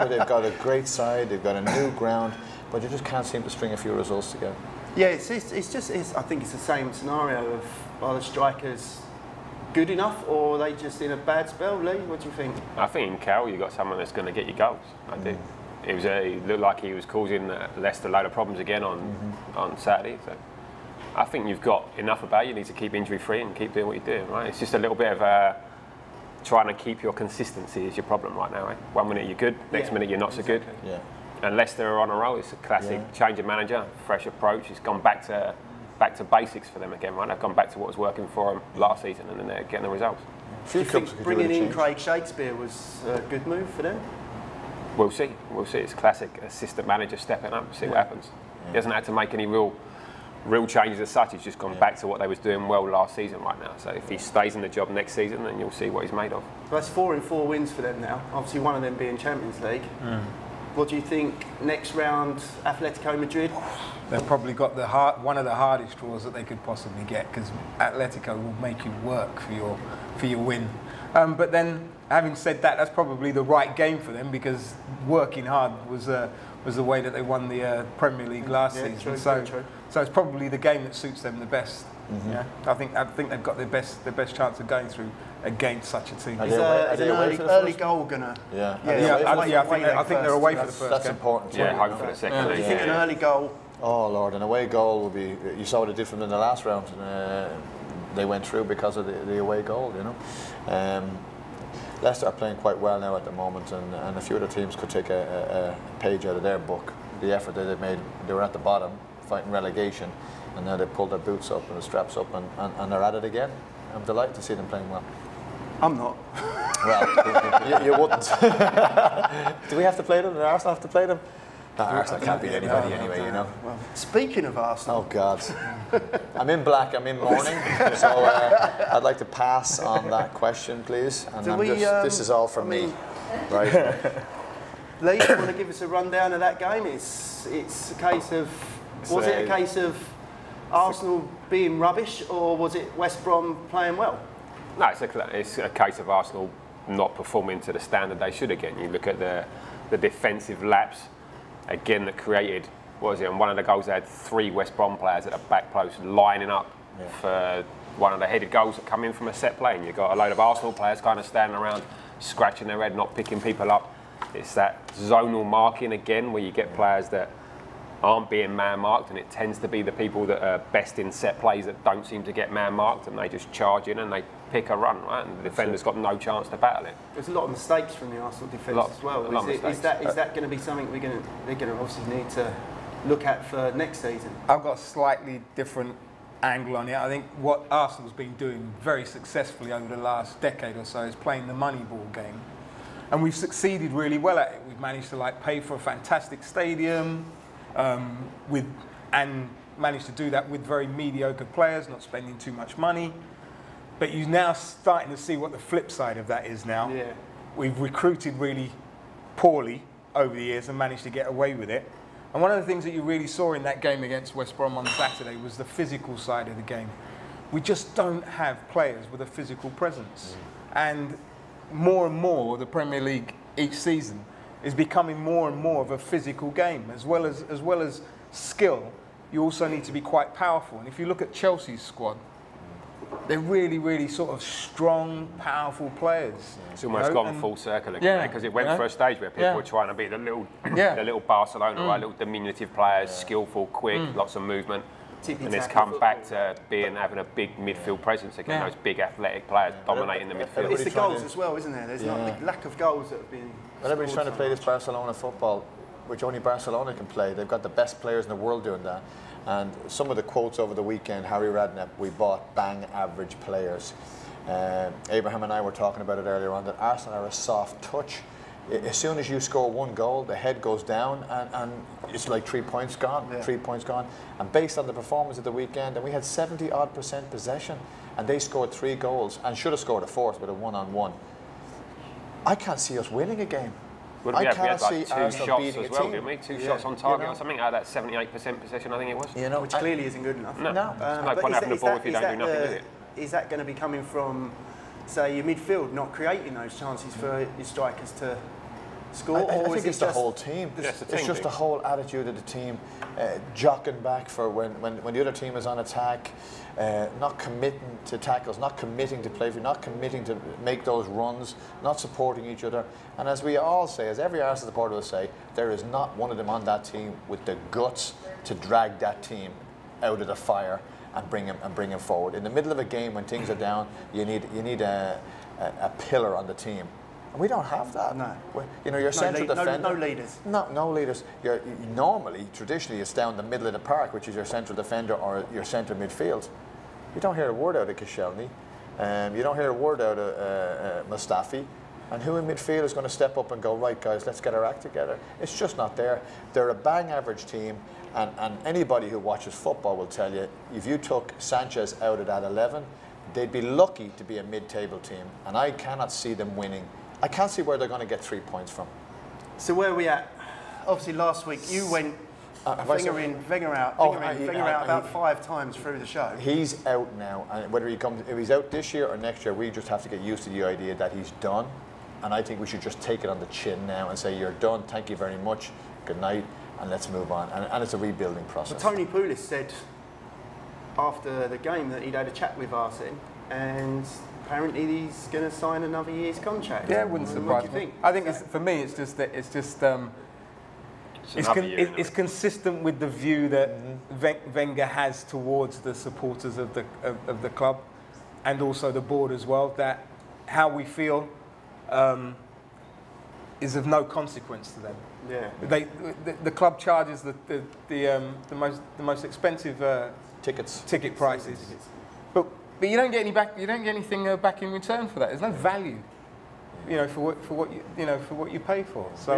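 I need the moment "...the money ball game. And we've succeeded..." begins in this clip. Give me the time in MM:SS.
03:11.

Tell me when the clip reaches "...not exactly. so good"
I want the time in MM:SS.
00:30.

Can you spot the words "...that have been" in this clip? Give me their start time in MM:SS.
04:13.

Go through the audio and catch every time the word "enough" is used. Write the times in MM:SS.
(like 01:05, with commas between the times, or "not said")
00:09, 00:21, 04:50.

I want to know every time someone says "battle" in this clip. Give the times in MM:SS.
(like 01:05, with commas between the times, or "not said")
02:56.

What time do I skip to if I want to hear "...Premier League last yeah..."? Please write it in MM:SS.
01:17.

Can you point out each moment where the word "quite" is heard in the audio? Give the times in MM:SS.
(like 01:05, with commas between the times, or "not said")
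01:42, 03:50.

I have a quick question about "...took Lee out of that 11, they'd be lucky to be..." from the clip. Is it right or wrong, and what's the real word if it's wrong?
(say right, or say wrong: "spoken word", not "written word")
wrong: "Sanchez", not "Lee".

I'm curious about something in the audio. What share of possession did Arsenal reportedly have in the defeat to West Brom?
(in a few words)
78%.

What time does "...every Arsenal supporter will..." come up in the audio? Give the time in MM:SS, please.
05:14.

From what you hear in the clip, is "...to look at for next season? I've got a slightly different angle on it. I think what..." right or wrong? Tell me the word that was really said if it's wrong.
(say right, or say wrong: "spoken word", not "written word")
right.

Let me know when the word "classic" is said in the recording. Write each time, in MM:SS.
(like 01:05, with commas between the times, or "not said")
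00:32, 00:45.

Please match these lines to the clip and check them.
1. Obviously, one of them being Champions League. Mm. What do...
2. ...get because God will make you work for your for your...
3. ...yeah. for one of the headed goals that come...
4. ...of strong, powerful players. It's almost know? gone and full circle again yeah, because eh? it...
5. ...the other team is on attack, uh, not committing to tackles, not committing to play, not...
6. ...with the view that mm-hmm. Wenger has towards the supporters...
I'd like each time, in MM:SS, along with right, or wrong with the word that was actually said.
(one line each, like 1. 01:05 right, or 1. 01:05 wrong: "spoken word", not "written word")
1. 00:58 right
2. 01:07 wrong: "Atletico", not "God"
3. 02:36 right
4. 03:54 right
5. 05:05 right
6. 06:32 right.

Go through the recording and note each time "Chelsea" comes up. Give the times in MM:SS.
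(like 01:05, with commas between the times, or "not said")
03:51.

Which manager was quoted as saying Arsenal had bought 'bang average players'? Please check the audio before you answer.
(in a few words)
Harry Redknapp.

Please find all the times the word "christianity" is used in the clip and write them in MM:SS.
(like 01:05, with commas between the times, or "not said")
not said.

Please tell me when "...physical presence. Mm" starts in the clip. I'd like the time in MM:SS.
03:39.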